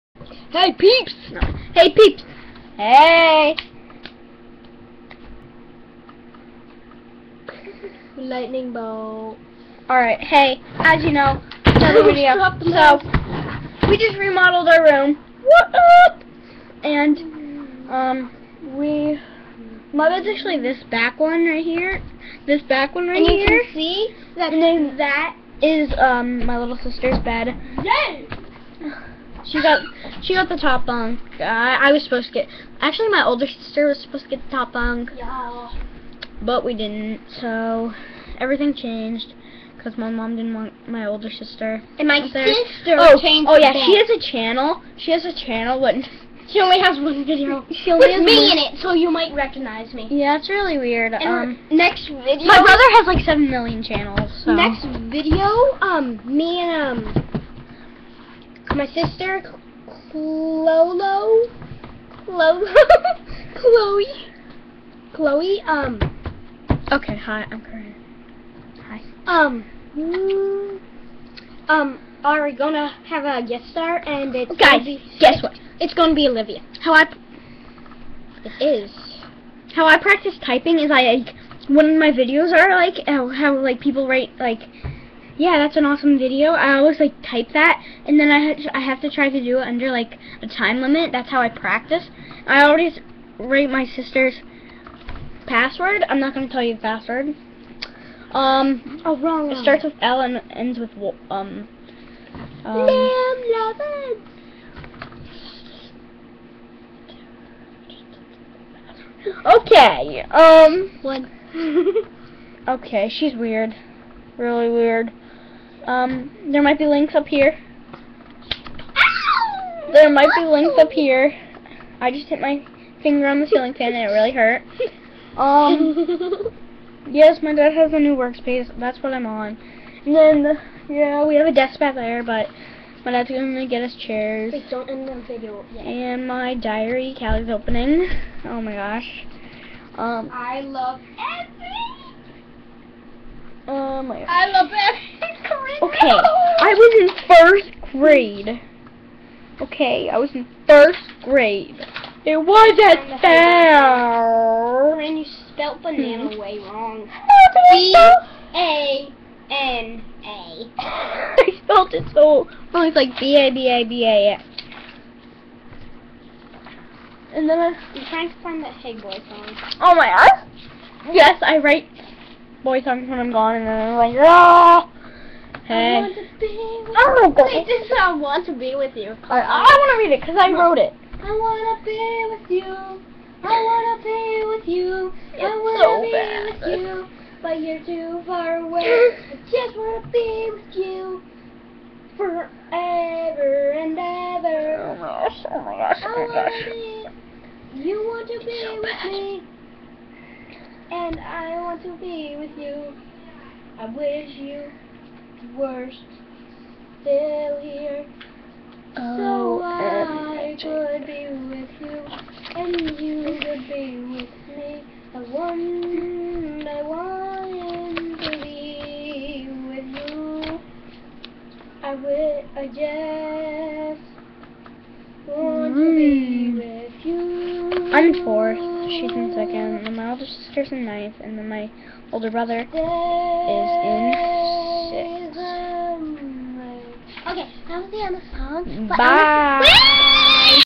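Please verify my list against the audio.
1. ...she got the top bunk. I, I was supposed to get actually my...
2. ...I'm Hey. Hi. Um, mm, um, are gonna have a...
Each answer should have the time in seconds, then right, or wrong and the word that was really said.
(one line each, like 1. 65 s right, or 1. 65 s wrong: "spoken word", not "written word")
1. 30 s right
2. 67 s wrong: "Corinne", not "Hey".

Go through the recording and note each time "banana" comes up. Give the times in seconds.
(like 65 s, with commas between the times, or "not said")
155 s.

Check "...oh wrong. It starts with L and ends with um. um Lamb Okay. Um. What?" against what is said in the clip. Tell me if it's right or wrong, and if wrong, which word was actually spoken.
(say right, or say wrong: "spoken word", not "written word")
right.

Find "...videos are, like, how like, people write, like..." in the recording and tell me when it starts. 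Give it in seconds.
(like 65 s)
82 s.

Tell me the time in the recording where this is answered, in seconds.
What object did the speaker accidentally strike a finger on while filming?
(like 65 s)
123 s.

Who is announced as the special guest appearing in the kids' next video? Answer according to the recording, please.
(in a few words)
Olivia.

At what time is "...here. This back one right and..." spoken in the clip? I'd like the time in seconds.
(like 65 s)
21 s.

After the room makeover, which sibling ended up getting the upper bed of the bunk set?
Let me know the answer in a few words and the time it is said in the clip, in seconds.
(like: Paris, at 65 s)
Little sister, at 26 s.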